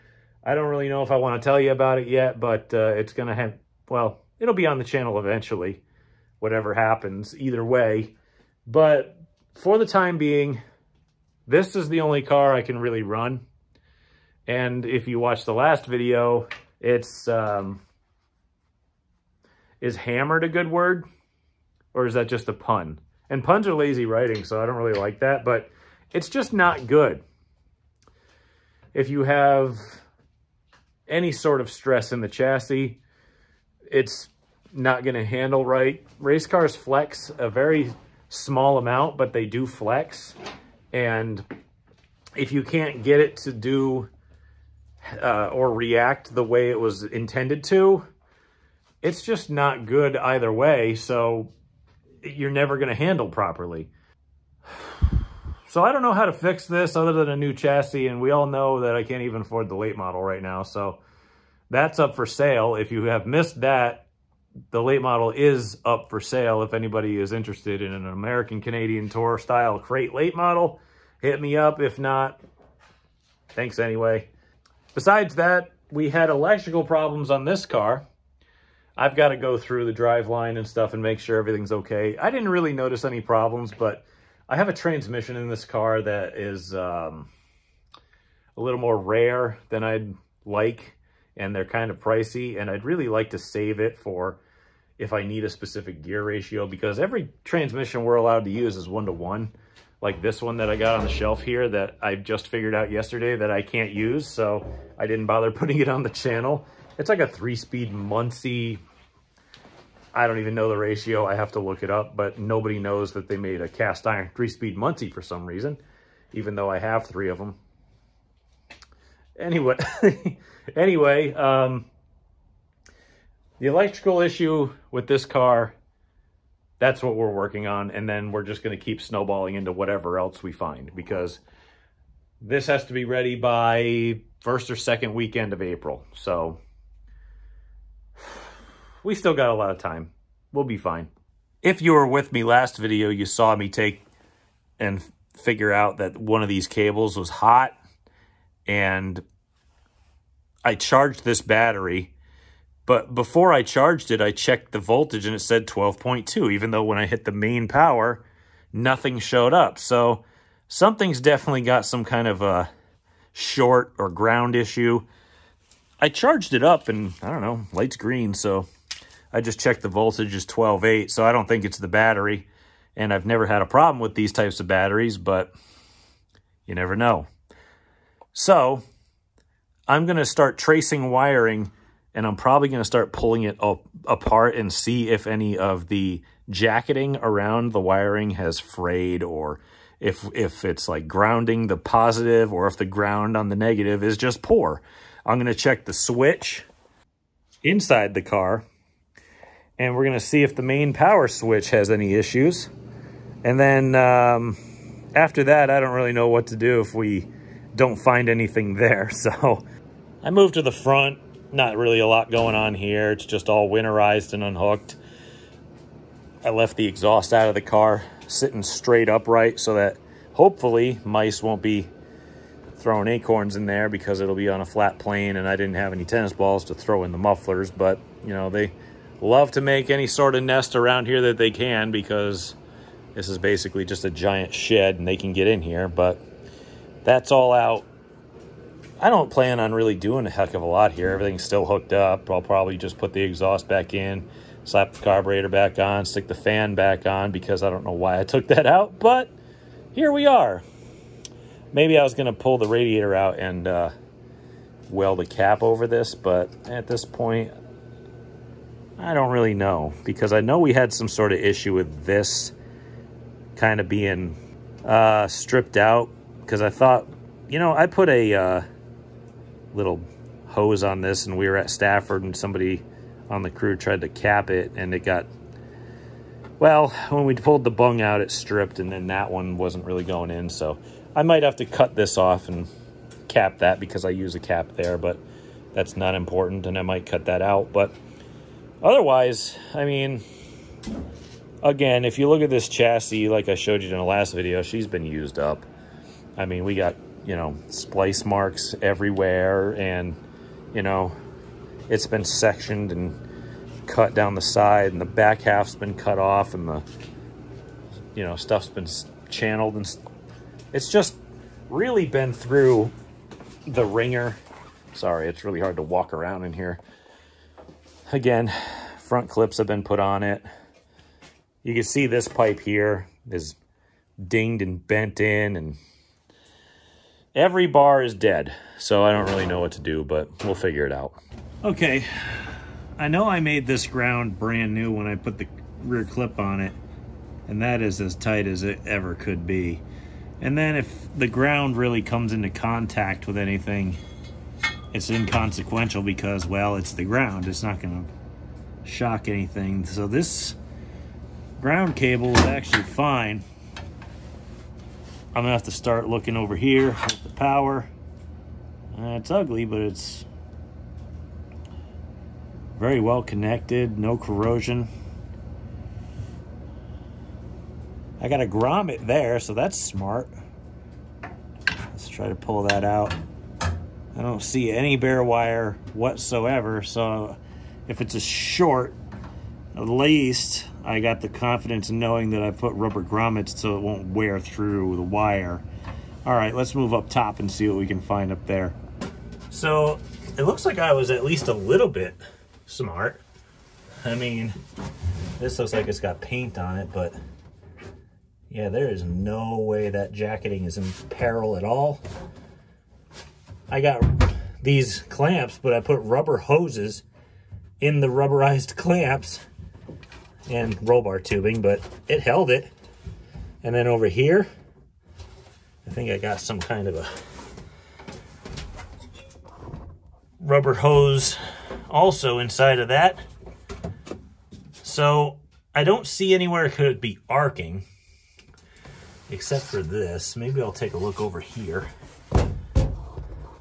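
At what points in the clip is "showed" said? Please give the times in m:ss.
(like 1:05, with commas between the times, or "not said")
2:39, 4:53.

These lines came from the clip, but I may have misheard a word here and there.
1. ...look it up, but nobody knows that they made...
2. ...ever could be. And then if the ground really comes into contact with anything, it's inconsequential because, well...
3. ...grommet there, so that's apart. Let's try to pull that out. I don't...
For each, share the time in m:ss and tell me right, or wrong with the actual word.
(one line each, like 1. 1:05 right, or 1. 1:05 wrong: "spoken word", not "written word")
1. 1:51 right
2. 5:38 right
3. 6:08 wrong: "smart", not "apart".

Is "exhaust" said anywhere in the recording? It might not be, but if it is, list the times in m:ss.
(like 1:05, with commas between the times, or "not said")
3:36, 4:03.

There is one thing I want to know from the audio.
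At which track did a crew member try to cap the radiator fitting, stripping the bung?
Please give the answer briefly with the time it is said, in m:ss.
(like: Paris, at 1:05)
Stafford, at 4:31.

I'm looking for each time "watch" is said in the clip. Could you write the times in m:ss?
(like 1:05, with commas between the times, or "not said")
0:15.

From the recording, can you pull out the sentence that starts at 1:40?
Like this one that I got on the shelf here that I just figured out yesterday that I can't use.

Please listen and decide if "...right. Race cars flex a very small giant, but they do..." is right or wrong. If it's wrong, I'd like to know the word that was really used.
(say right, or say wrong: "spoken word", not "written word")
wrong: "amount", not "giant".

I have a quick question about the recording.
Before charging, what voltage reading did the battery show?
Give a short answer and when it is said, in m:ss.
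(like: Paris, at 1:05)
12.2, at 2:35.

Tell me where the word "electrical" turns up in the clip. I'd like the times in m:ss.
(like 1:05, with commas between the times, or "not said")
1:16, 2:03.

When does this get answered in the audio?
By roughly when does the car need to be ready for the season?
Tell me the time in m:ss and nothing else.
2:14.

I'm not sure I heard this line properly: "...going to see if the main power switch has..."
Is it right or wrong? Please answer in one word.
right.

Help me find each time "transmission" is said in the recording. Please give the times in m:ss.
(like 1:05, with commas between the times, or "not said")
1:24, 1:37.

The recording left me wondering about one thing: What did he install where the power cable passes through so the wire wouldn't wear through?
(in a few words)
rubber grommets.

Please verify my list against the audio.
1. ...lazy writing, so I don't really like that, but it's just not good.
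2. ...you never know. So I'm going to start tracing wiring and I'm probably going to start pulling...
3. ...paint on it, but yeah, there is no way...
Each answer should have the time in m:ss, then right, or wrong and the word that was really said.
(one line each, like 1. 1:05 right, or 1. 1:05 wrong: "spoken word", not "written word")
1. 0:23 right
2. 2:56 right
3. 6:36 right.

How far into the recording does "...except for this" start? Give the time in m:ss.
7:09.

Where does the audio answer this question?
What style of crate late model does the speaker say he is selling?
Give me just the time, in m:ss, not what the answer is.
1:08.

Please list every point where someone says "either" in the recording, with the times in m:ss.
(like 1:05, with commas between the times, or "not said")
0:07, 0:50.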